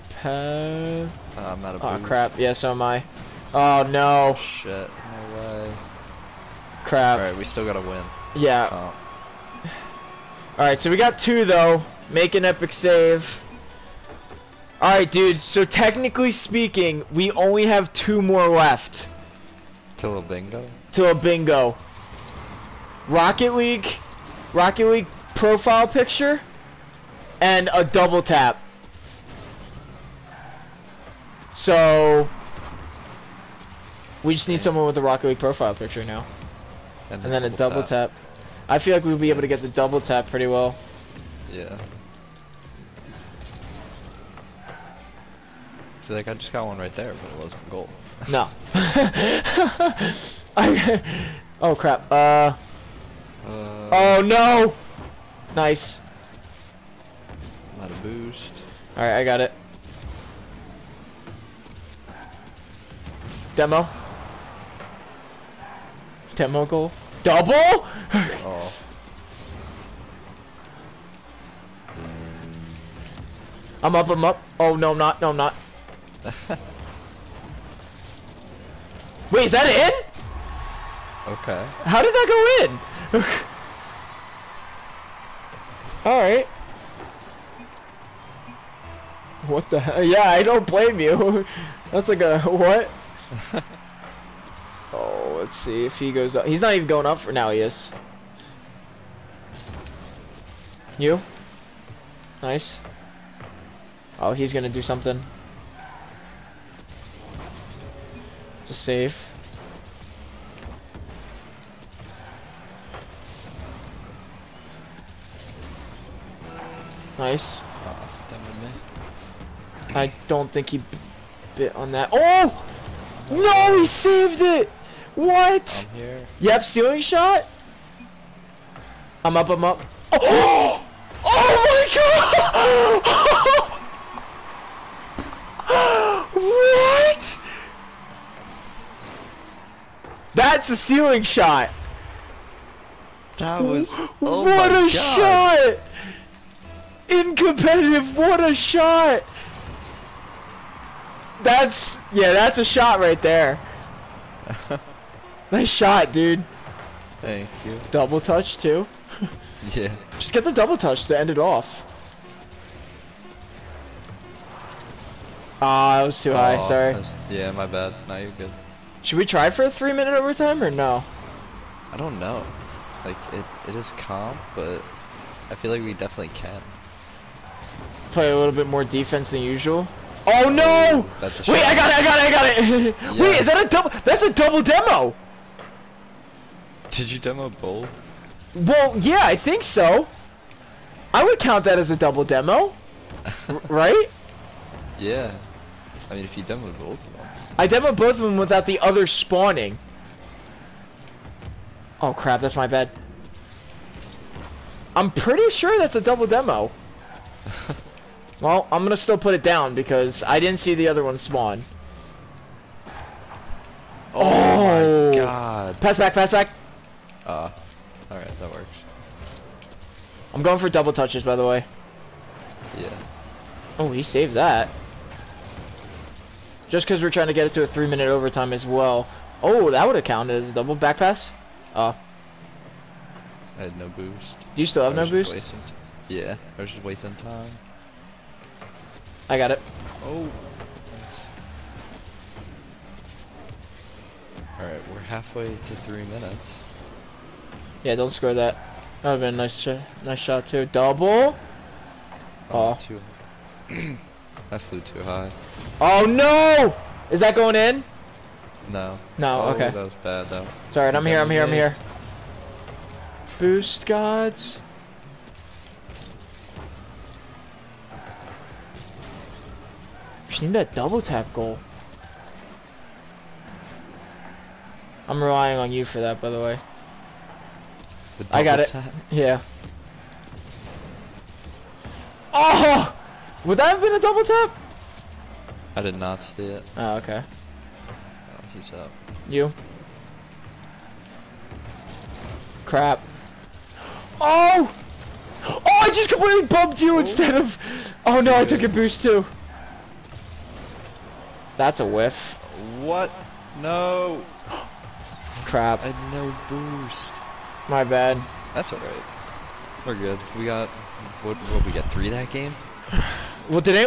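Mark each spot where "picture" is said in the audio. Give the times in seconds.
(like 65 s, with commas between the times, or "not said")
25 s, 35 s.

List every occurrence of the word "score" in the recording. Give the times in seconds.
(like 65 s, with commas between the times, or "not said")
248 s.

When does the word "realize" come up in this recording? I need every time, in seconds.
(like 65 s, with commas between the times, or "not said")
not said.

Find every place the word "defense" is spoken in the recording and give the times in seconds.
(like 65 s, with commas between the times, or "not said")
178 s.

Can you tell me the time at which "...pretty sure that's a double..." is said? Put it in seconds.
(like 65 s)
205 s.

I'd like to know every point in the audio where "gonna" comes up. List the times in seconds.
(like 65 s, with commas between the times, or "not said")
104 s, 208 s.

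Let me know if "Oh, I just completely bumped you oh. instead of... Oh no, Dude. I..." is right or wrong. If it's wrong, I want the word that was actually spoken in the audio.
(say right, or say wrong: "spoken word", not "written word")
right.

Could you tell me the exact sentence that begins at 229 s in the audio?
Oh, that would have counted as a double back pass.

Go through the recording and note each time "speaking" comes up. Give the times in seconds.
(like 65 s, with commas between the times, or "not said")
16 s.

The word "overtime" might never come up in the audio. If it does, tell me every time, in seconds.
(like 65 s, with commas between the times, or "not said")
170 s, 228 s.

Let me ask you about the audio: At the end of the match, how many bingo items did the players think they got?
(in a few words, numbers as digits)
3.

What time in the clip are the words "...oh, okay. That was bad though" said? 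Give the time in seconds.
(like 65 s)
259 s.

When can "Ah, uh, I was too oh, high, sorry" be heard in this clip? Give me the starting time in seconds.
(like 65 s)
165 s.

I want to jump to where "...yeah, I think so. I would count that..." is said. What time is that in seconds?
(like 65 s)
188 s.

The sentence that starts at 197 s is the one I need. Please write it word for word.
I demoed both of them without the other spawning.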